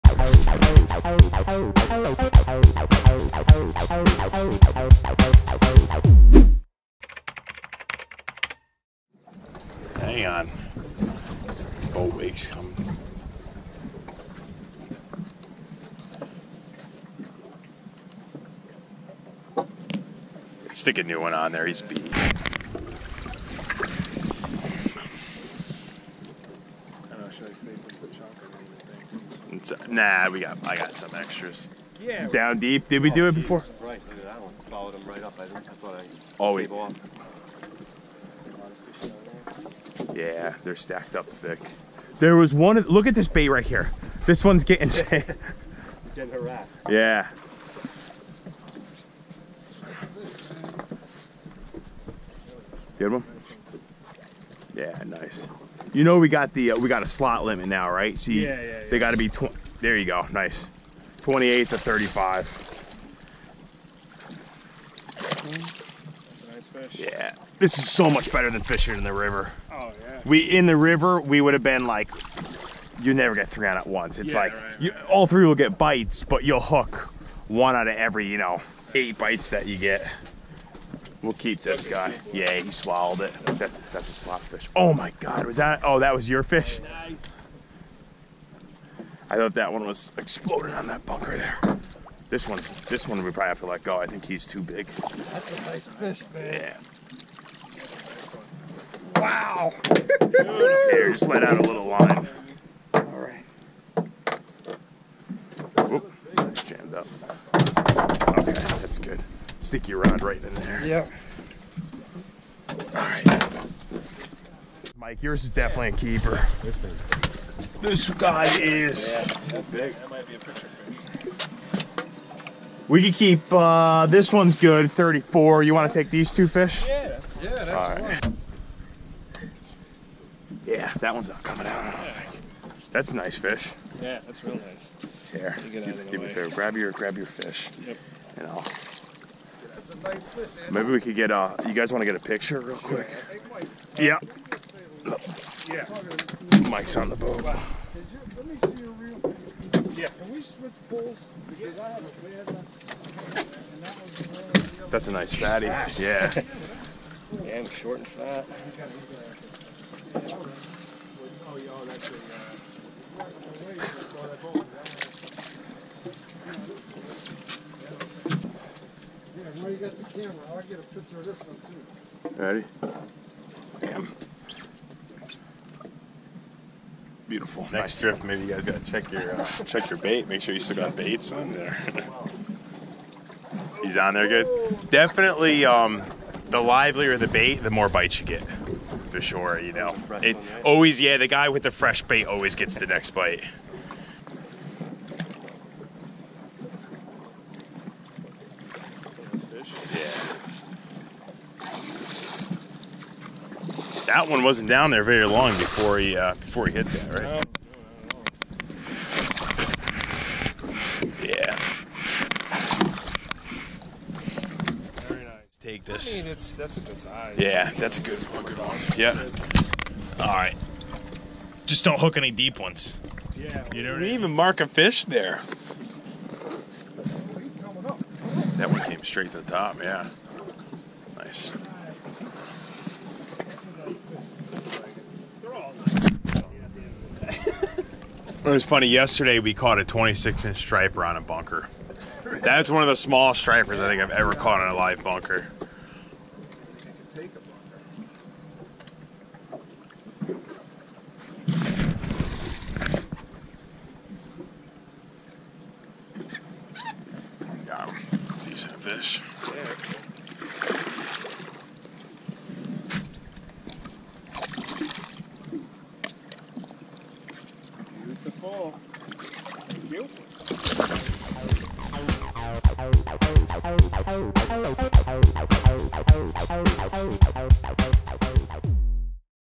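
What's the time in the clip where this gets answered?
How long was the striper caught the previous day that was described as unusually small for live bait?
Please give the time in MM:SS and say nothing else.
03:59.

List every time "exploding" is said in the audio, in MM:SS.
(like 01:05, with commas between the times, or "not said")
01:30.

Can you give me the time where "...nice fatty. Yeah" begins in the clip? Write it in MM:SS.
02:35.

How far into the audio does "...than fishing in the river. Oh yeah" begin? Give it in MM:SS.
01:08.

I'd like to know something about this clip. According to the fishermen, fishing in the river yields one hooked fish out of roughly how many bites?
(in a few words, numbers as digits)
8.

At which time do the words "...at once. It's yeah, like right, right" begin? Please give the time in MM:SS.
01:13.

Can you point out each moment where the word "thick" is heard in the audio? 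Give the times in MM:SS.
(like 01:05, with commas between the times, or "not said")
00:41.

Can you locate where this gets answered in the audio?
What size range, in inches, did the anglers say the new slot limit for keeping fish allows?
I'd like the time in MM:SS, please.
01:01.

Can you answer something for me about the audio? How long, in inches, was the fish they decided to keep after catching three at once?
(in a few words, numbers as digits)
34.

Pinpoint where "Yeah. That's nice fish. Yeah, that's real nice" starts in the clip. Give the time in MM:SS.
02:11.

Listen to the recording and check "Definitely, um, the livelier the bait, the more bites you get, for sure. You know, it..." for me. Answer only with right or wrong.
right.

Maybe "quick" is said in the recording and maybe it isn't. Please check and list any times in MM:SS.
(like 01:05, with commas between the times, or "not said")
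02:22.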